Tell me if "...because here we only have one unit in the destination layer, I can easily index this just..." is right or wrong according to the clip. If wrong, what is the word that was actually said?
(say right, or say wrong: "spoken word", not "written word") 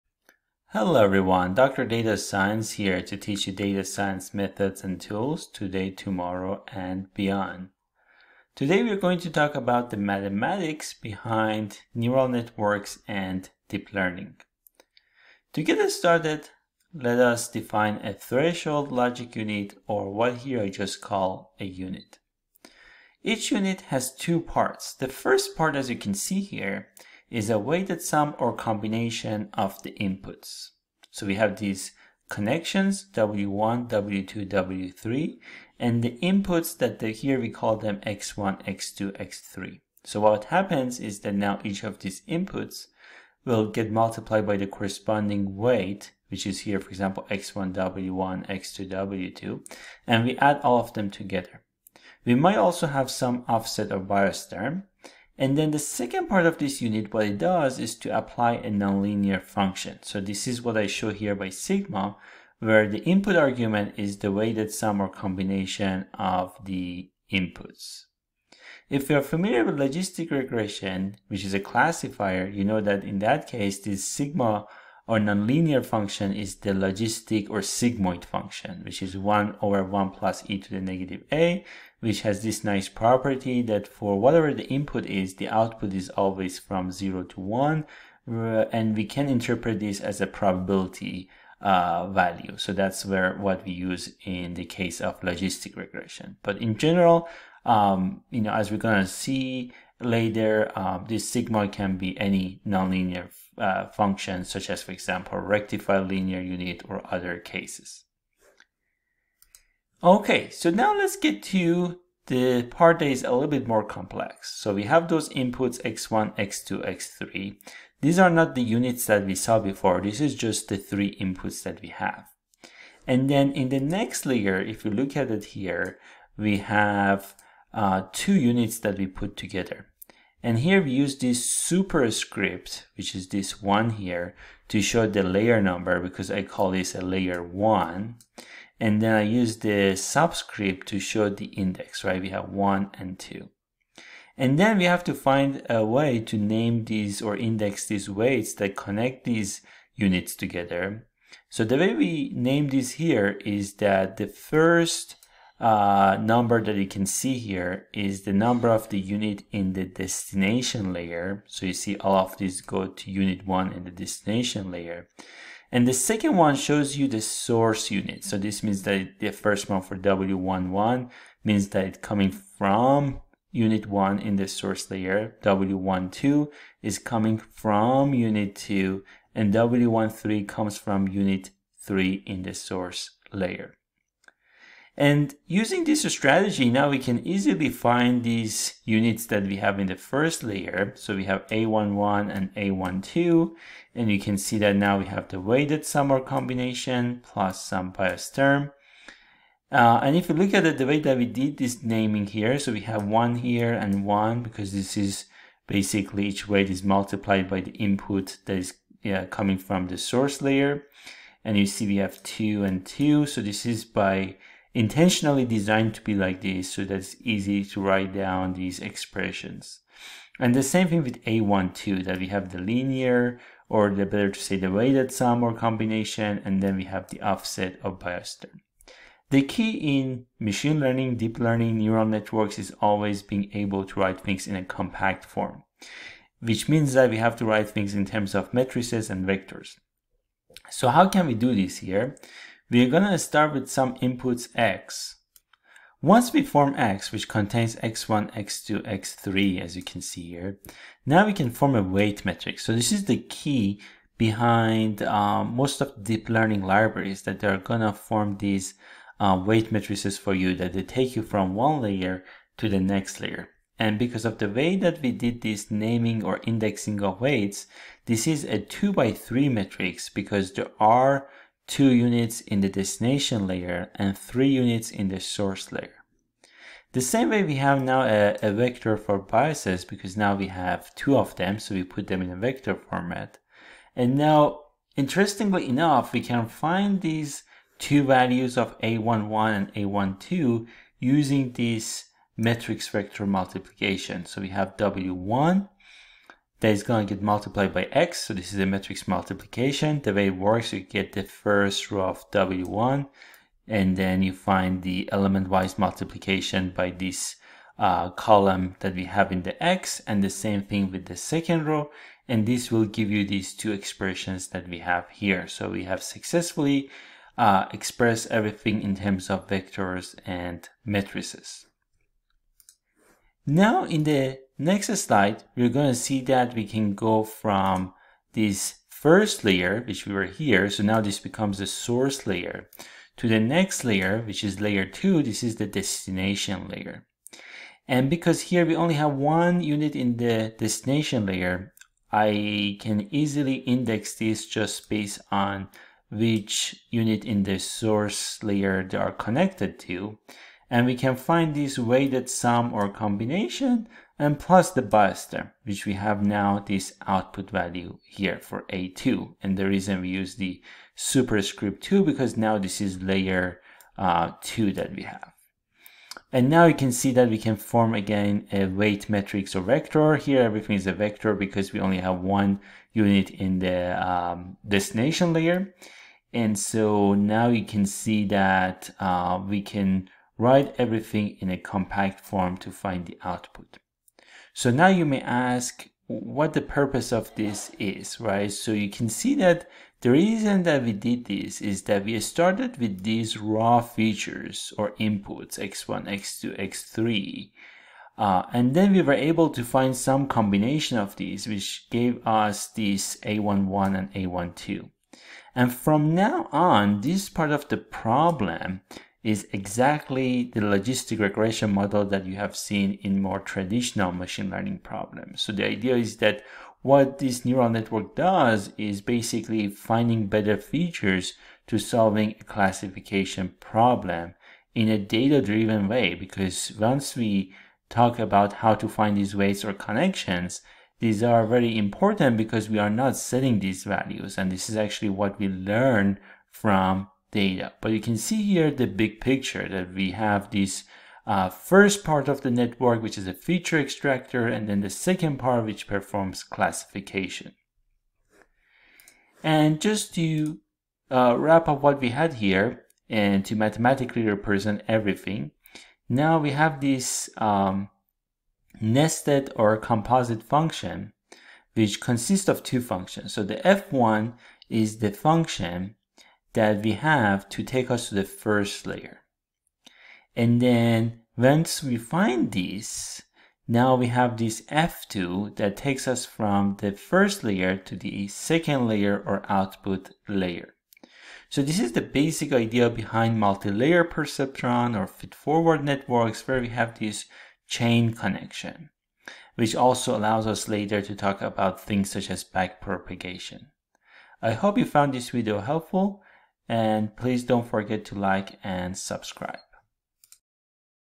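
right.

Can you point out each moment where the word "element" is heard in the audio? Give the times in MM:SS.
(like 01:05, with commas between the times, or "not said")
05:05.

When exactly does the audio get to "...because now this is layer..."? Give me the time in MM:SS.
06:02.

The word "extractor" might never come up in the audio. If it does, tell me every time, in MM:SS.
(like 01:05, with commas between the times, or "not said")
07:23.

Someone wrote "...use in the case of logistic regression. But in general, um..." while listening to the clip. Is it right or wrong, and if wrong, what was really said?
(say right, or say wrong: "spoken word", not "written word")
right.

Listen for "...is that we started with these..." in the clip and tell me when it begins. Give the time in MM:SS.
06:31.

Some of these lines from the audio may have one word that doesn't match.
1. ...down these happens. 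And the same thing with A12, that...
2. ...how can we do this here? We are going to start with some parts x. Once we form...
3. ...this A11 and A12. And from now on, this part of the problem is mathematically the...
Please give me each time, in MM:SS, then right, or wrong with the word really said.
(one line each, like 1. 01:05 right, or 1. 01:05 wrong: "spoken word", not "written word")
1. 03:38 wrong: "expressions", not "happens"
2. 04:00 wrong: "inputs", not "parts"
3. 06:42 wrong: "exactly", not "mathematically".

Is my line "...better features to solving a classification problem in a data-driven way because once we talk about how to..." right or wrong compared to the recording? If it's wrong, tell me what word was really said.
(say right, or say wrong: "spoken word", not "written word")
right.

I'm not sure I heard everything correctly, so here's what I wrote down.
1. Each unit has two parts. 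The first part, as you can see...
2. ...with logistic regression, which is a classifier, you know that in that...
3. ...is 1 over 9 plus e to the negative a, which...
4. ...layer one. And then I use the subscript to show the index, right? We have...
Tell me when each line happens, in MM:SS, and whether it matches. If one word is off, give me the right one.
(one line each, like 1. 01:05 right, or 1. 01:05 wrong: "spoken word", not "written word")
1. 00:23 right
2. 01:09 right
3. 01:19 wrong: "1", not "9"
4. 02:17 right.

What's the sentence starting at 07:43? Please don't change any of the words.
So the F1 is the function that we have to take us to the first layer.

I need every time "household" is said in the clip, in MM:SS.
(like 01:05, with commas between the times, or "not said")
not said.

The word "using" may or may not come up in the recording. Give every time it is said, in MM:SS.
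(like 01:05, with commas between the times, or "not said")
03:05, 04:50.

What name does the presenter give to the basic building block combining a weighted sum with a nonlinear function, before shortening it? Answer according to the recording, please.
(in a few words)
threshold logic unit.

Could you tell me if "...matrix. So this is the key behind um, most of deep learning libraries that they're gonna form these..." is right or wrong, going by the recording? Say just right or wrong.
right.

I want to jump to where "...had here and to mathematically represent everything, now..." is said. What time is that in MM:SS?
07:32.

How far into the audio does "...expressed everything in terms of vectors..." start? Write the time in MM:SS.
05:17.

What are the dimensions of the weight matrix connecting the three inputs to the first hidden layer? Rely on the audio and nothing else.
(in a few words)
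2 by 3.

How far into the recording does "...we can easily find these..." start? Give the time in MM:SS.
03:06.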